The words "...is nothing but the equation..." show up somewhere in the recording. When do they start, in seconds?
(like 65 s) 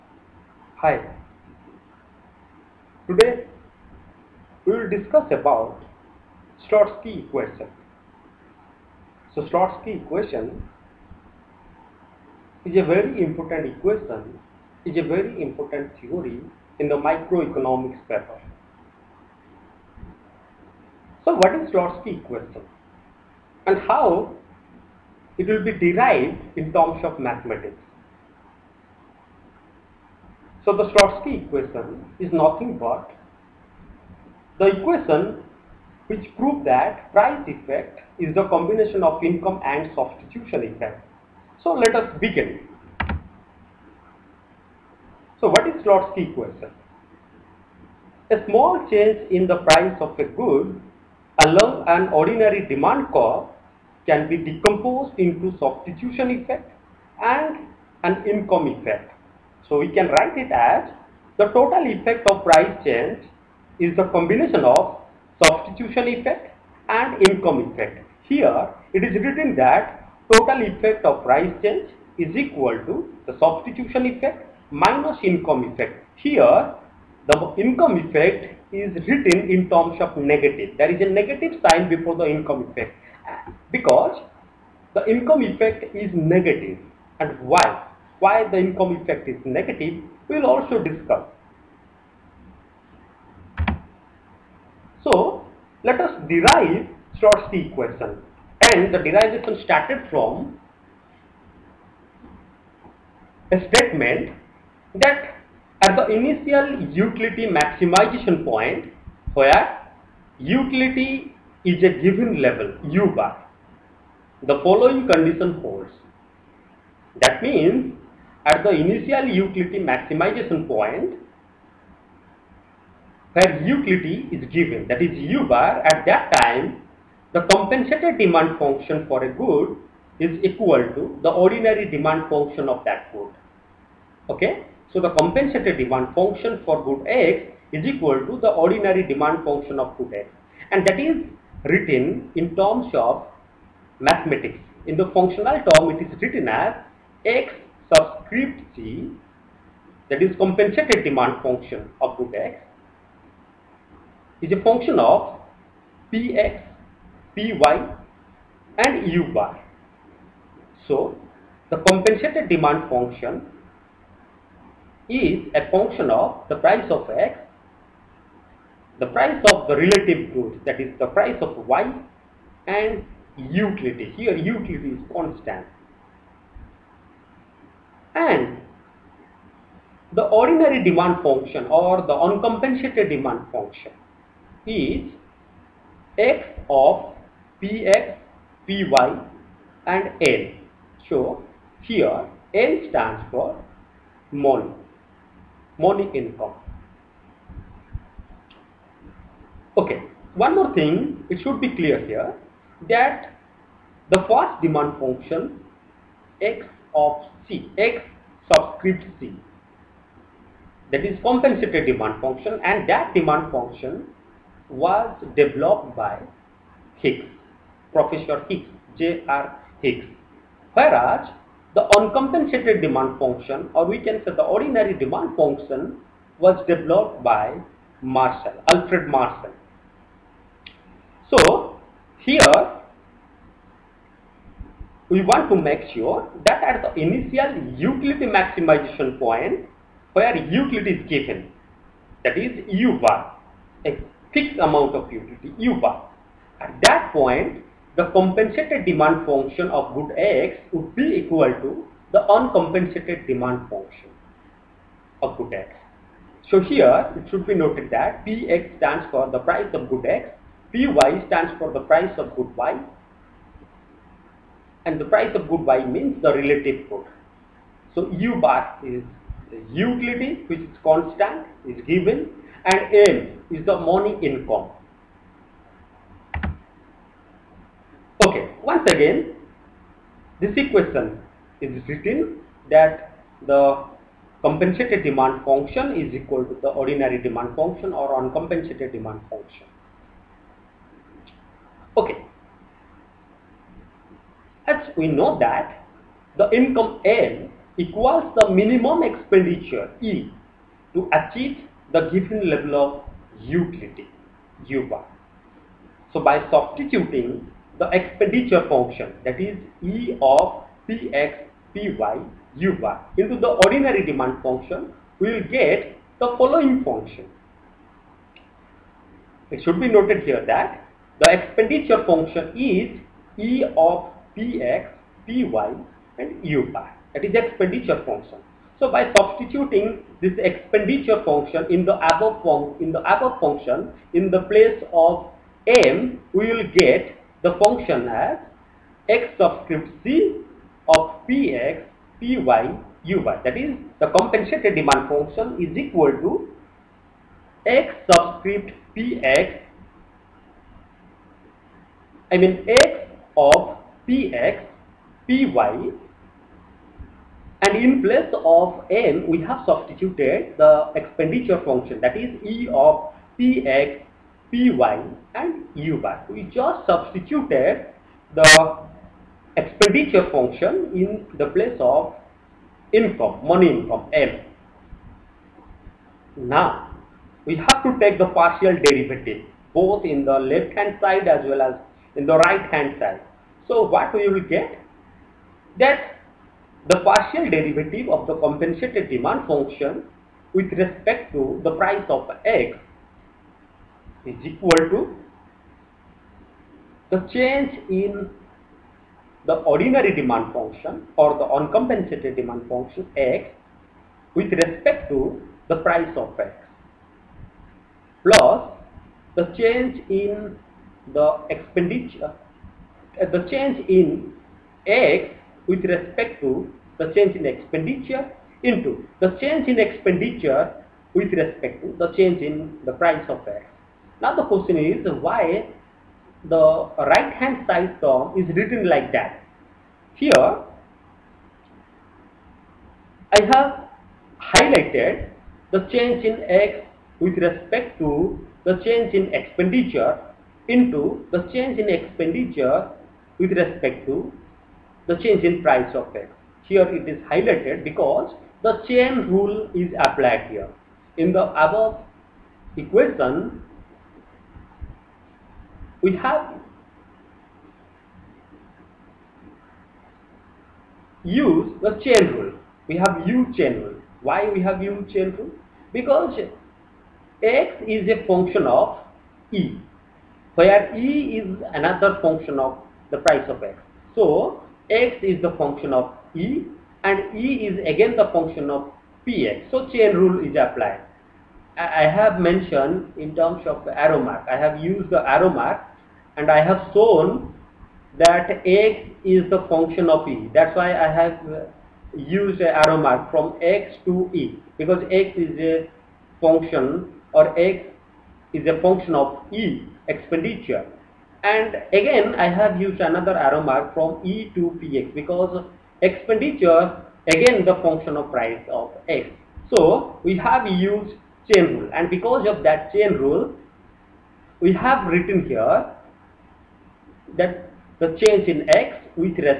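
32 s.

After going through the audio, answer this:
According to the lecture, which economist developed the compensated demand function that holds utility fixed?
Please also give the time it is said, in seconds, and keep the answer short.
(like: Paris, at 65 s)
J.R. Hicks, at 217 s.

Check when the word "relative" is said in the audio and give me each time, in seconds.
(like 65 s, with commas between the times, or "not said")
169 s, 266 s.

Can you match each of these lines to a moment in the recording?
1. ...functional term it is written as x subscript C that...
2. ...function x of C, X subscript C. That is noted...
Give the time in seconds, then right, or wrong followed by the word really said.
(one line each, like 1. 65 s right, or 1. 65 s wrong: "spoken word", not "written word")
1. 145 s right
2. 204 s wrong: "compensated", not "noted".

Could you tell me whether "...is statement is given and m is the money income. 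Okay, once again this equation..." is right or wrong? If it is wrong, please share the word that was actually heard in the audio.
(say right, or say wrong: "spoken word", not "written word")
wrong: "constant", not "statement".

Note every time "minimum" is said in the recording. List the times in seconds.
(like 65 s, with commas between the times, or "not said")
298 s.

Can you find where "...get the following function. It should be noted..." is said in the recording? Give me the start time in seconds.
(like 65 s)
315 s.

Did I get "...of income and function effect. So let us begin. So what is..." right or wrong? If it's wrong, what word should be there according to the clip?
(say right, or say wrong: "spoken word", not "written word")
wrong: "substitution", not "function".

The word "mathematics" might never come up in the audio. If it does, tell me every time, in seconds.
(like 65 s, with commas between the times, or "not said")
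27 s, 144 s.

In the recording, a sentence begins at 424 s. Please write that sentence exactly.
Now the question is why the right hand side term is written like that.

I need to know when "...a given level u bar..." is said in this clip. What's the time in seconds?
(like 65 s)
111 s.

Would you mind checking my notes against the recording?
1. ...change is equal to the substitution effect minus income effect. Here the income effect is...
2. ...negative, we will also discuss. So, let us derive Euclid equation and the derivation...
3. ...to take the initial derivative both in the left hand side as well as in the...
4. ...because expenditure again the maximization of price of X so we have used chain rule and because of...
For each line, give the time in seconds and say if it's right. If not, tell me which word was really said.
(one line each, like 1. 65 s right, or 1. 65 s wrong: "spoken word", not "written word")
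1. 71 s right
2. 89 s wrong: "Slutsky", not "Euclid"
3. 377 s wrong: "partial", not "initial"
4. 505 s wrong: "function", not "maximization".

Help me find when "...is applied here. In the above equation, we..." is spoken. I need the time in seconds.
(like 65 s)
449 s.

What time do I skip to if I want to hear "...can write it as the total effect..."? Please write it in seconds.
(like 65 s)
59 s.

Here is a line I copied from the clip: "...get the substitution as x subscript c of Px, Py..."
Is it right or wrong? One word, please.
wrong.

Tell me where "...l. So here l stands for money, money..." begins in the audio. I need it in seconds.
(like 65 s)
190 s.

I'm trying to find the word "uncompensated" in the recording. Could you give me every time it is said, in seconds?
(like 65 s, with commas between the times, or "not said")
182 s, 221 s, 252 s, 288 s, 401 s.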